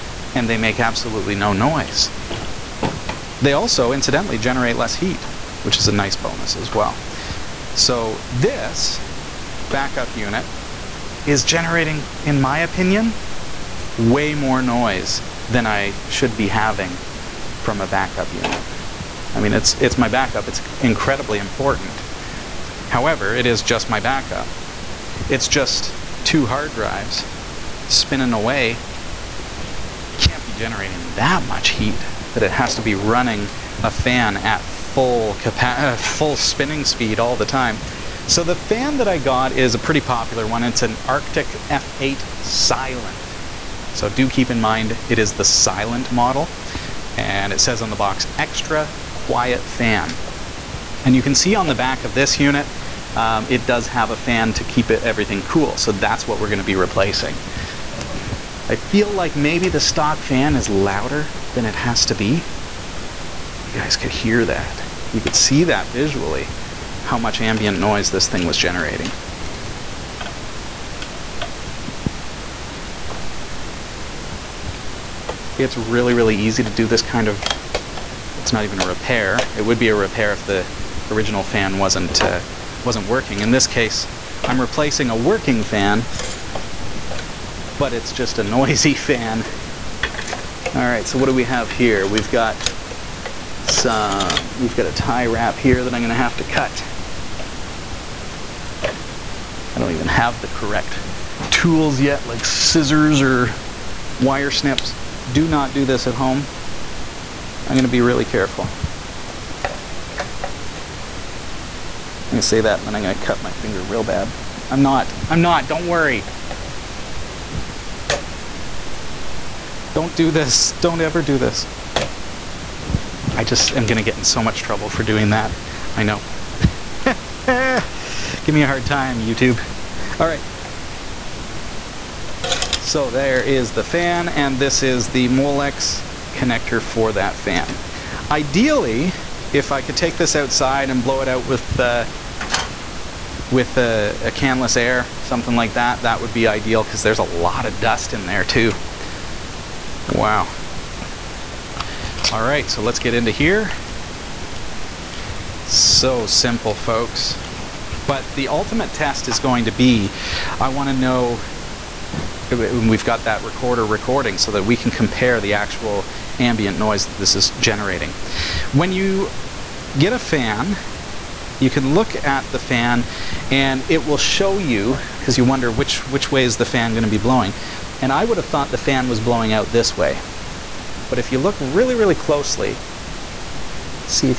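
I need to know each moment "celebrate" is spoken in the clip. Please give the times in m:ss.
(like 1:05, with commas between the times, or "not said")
not said.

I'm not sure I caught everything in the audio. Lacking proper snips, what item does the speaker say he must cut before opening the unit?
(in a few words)
tie wrap.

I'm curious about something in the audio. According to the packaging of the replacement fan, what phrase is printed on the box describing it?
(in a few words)
extra quiet fan.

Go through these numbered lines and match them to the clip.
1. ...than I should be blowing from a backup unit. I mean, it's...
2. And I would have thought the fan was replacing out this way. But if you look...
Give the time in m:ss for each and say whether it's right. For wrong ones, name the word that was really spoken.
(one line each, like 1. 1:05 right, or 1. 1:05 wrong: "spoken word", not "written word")
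1. 0:15 wrong: "having", not "blowing"
2. 2:58 wrong: "blowing", not "replacing".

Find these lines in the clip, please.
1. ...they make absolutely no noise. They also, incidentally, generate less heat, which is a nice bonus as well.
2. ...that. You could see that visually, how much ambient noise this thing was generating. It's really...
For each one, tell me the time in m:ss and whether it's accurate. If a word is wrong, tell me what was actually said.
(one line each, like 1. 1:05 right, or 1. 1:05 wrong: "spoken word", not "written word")
1. 0:00 right
2. 1:04 right.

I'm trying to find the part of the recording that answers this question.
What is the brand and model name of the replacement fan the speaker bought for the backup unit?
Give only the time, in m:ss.
0:41.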